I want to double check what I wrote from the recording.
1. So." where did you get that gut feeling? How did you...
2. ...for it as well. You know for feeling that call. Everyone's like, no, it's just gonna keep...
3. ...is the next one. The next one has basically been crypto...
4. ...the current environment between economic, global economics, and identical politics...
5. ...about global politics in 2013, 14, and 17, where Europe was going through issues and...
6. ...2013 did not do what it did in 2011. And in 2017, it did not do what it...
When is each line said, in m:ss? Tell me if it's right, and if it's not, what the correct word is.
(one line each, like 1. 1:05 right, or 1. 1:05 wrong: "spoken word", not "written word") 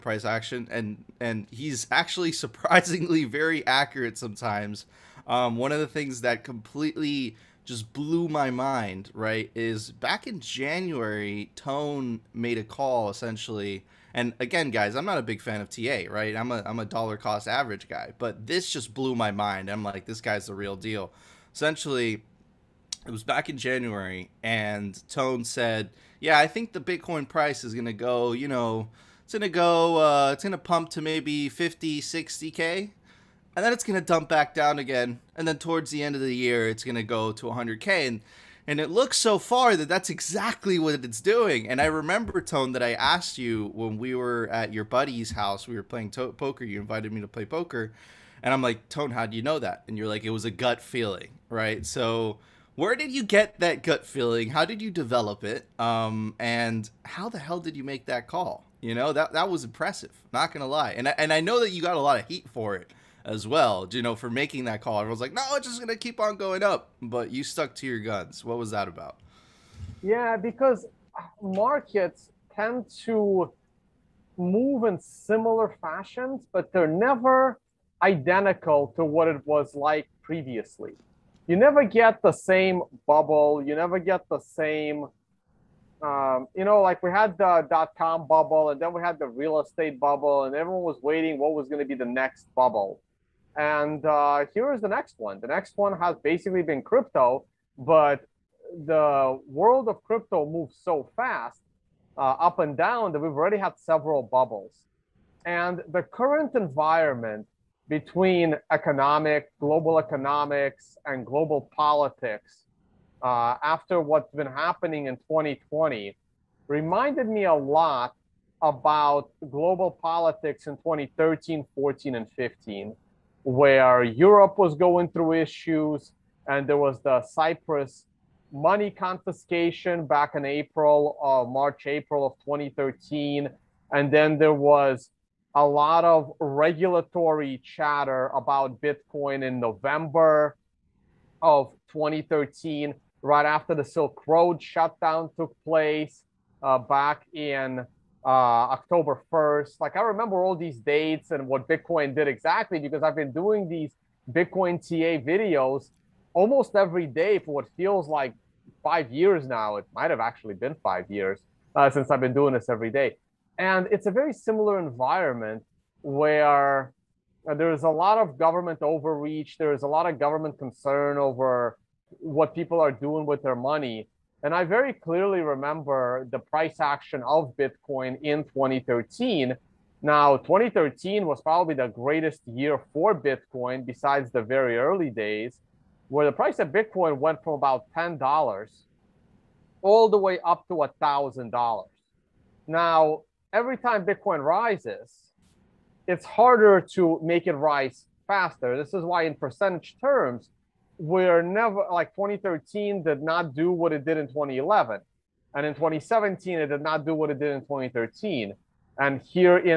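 1. 0:51 right
2. 1:02 wrong: "making", not "feeling"
3. 1:34 right
4. 1:45 wrong: "global", not "identical"
5. 1:58 wrong: "15", not "17"
6. 3:22 right.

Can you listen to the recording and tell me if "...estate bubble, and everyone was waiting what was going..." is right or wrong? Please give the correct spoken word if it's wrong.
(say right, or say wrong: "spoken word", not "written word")
right.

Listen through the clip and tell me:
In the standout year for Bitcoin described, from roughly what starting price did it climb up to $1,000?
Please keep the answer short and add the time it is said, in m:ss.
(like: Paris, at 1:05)
$10, at 3:07.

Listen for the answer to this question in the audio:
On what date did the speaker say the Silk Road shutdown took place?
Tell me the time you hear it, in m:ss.
2:28.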